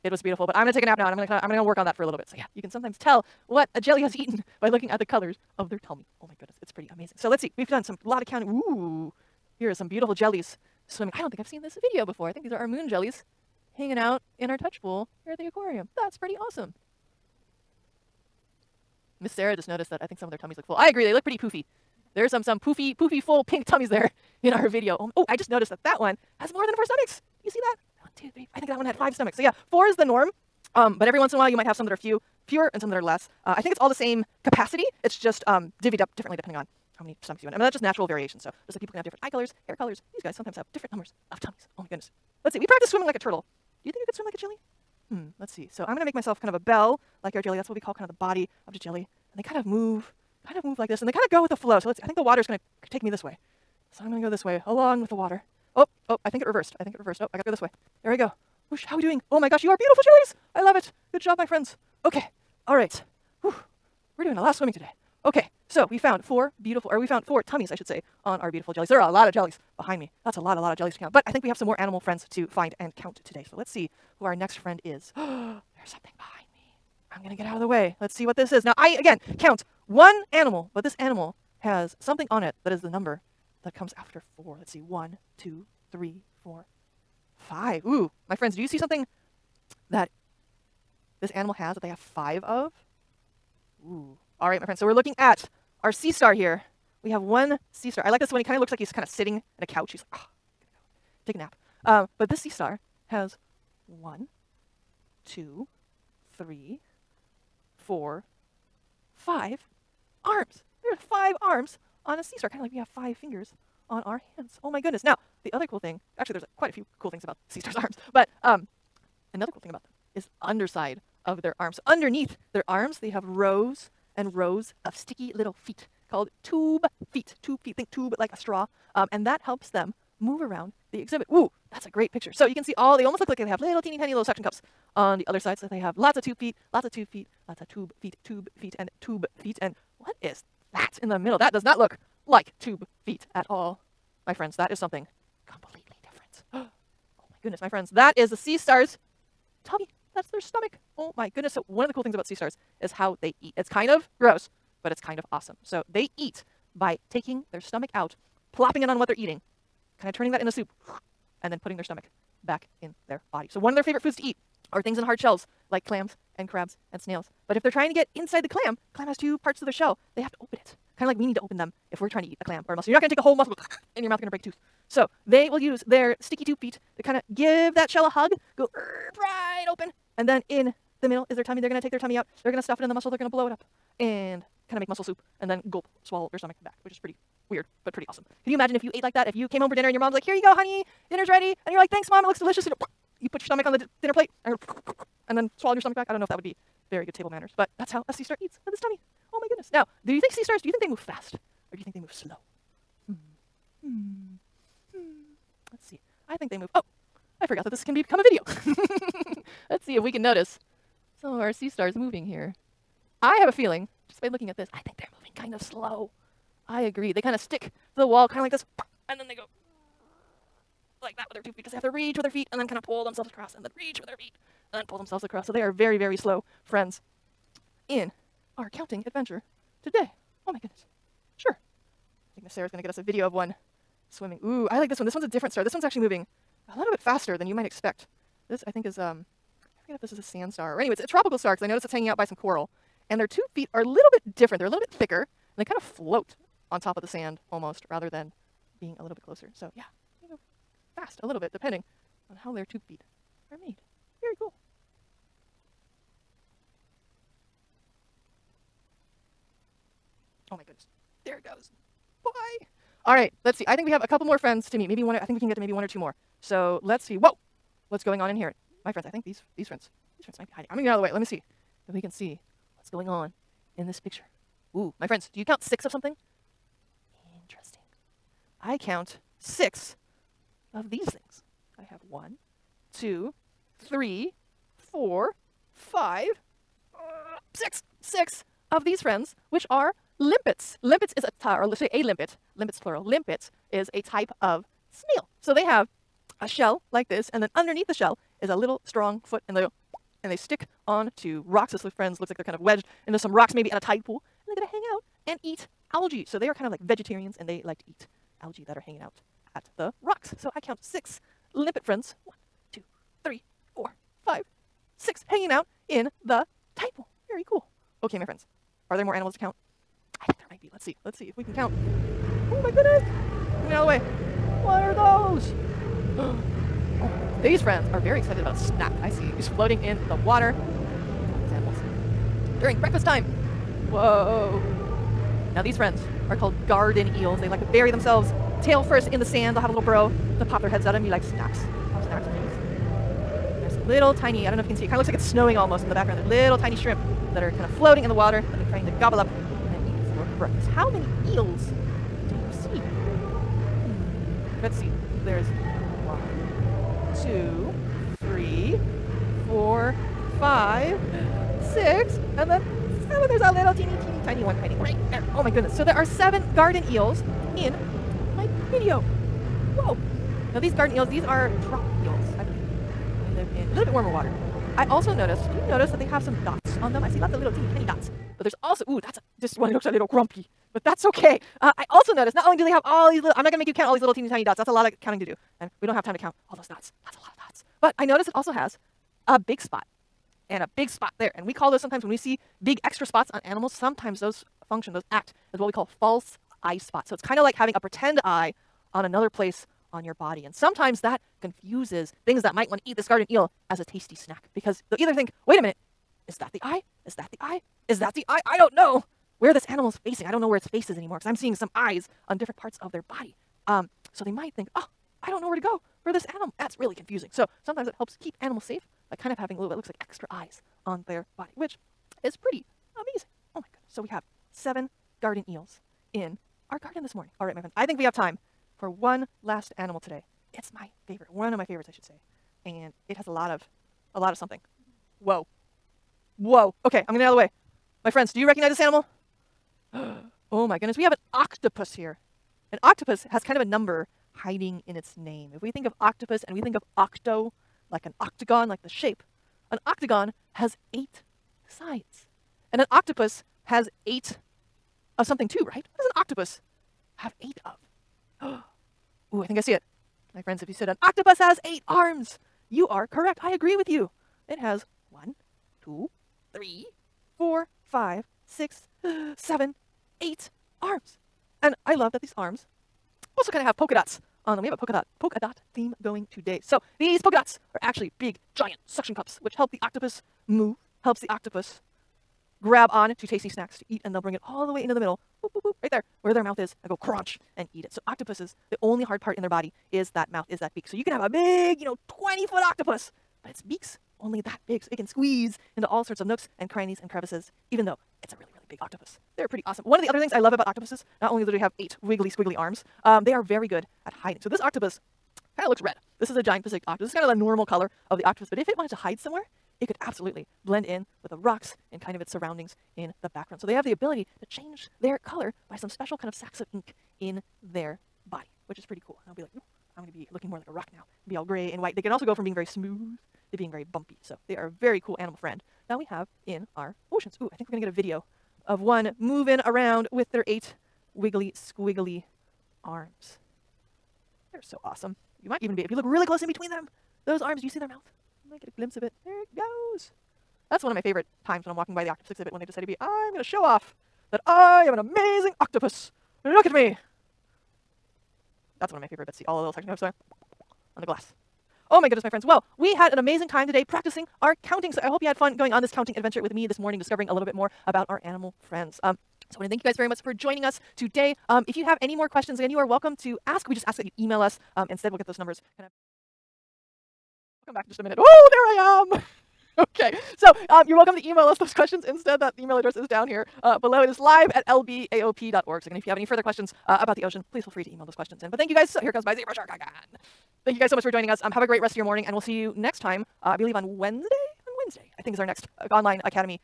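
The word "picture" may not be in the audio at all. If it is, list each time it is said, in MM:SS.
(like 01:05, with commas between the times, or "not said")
02:12, 04:33.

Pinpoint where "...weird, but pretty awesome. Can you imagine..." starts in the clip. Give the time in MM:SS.
03:07.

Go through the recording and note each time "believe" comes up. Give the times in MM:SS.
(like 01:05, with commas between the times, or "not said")
09:43.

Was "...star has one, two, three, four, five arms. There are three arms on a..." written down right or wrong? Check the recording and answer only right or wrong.
wrong.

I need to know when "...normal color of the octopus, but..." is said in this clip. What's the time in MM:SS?
08:27.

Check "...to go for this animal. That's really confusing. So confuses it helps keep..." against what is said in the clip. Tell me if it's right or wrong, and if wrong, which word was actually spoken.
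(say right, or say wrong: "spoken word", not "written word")
wrong: "sometimes", not "confuses".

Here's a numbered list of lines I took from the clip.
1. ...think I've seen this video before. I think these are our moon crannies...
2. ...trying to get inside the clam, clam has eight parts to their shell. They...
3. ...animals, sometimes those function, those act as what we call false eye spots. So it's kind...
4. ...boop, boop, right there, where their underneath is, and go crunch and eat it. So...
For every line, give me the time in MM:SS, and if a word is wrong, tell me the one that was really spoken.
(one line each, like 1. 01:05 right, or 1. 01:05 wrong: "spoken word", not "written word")
1. 00:11 wrong: "jellies", not "crannies"
2. 02:47 wrong: "two", not "eight"
3. 06:33 right
4. 08:05 wrong: "mouth", not "underneath".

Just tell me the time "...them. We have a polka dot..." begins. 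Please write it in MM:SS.
07:54.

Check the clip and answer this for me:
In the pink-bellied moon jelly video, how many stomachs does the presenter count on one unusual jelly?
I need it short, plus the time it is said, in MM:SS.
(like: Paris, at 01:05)
5, at 00:28.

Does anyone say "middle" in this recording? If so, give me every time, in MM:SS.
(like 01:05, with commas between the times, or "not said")
02:21, 03:01, 08:04.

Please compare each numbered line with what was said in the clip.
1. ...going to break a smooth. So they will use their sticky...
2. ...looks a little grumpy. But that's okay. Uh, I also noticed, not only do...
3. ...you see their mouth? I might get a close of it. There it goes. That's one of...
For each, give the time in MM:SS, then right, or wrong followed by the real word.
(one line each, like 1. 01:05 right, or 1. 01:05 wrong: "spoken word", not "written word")
1. 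02:54 wrong: "tooth", not "smooth"
2. 06:19 right
3. 08:57 wrong: "glimpse", not "close".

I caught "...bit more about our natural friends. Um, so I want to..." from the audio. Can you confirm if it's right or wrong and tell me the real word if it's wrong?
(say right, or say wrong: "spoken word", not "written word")
wrong: "animal", not "natural".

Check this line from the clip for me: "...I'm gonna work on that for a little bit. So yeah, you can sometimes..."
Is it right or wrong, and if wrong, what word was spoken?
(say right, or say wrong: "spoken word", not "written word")
right.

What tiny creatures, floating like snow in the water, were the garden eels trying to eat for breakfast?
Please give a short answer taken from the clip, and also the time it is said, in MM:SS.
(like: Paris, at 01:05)
shrimp, at 05:46.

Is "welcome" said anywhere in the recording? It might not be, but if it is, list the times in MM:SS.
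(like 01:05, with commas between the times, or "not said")
09:22, 09:30.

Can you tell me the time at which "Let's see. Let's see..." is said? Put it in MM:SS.
05:20.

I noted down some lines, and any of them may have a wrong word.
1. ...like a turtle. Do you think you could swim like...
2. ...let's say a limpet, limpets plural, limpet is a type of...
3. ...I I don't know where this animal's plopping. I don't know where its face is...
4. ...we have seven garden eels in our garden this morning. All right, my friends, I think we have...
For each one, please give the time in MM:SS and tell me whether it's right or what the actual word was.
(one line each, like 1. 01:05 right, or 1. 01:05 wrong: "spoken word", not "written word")
1. 00:43 right
2. 04:51 right
3. 06:48 wrong: "facing", not "plopping"
4. 07:03 right.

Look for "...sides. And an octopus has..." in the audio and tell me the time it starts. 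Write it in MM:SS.
07:31.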